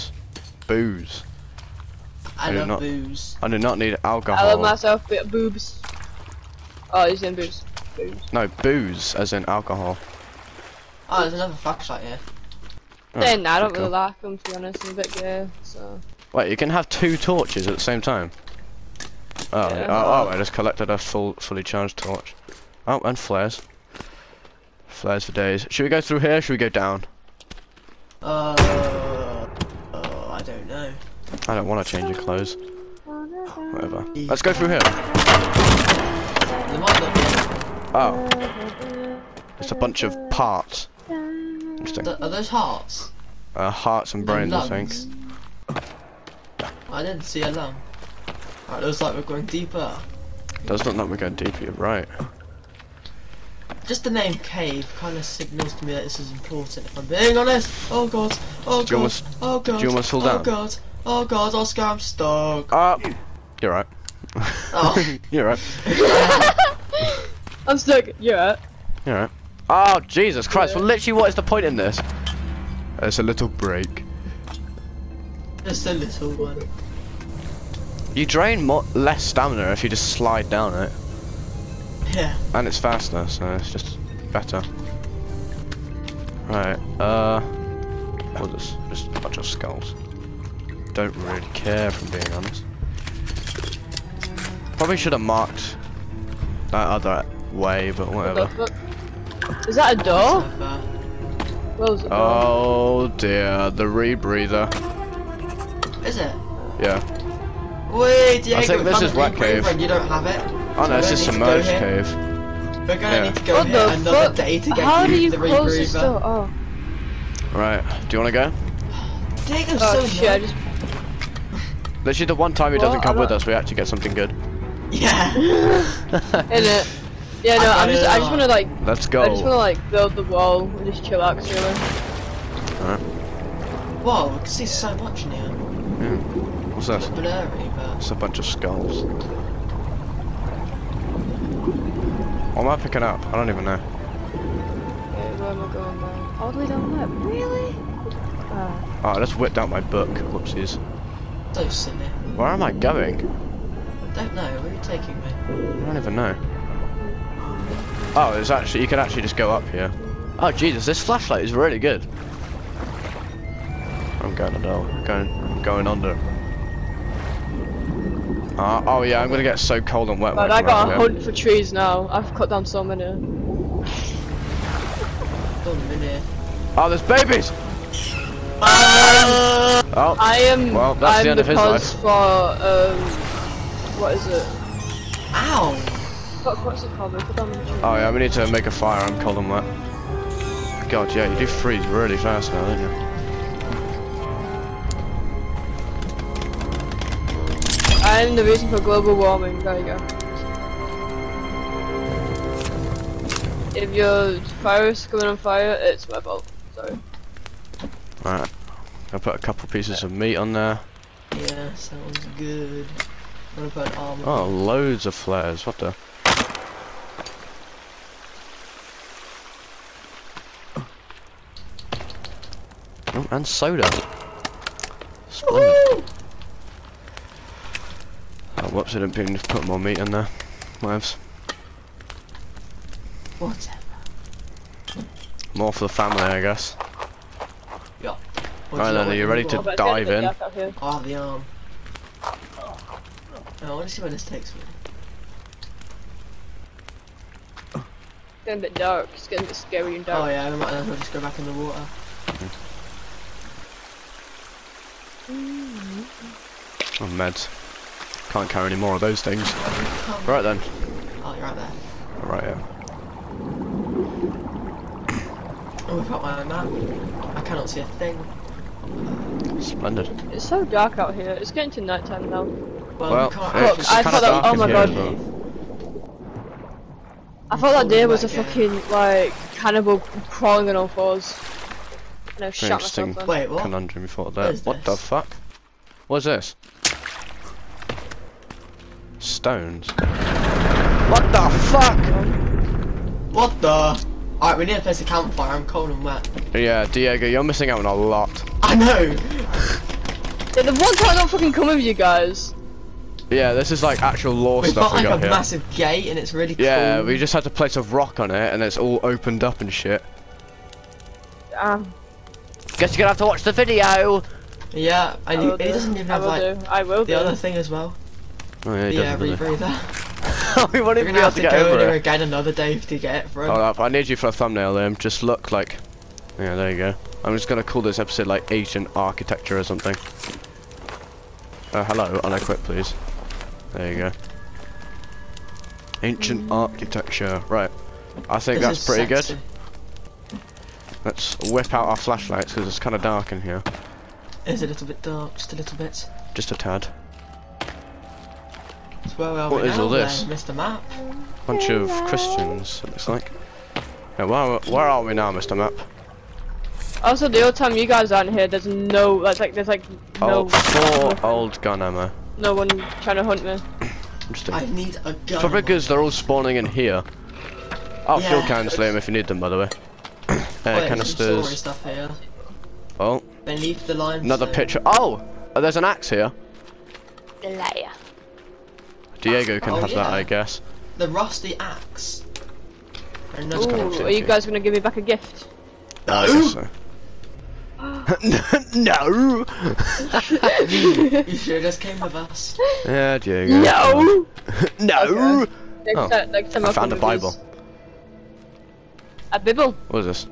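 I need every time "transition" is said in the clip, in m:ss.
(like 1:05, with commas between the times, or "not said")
not said.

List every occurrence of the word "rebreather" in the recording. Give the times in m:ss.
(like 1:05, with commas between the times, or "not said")
1:43, 5:19.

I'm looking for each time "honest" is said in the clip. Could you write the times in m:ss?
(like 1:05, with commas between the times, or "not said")
0:14, 0:57, 1:32.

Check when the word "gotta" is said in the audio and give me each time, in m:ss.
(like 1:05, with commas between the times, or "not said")
2:50.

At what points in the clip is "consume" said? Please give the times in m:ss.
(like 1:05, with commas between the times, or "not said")
not said.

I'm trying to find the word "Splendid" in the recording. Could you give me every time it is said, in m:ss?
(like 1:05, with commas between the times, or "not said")
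3:45, 4:29.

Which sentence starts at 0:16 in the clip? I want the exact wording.
Wait, you can have two torches at the same time?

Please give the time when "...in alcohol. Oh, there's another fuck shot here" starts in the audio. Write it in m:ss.
0:09.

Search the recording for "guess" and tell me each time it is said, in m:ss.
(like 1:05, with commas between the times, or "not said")
3:56, 5:12, 6:20, 6:26.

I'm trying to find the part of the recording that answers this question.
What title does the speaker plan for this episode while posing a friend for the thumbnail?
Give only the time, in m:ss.
5:28.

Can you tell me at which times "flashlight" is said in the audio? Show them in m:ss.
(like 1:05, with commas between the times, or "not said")
2:41, 5:41.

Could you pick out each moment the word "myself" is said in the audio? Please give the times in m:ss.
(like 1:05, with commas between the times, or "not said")
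0:04, 4:43.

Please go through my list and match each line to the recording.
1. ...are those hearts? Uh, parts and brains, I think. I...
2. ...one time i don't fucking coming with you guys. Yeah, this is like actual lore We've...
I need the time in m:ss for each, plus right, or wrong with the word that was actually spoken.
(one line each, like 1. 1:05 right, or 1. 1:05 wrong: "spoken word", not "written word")
1. 0:42 wrong: "hearts", not "parts"
2. 5:00 right.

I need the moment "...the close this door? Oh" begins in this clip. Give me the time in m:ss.
1:55.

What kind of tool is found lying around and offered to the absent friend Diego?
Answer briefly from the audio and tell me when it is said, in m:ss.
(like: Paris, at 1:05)
rusty axe, at 6:20.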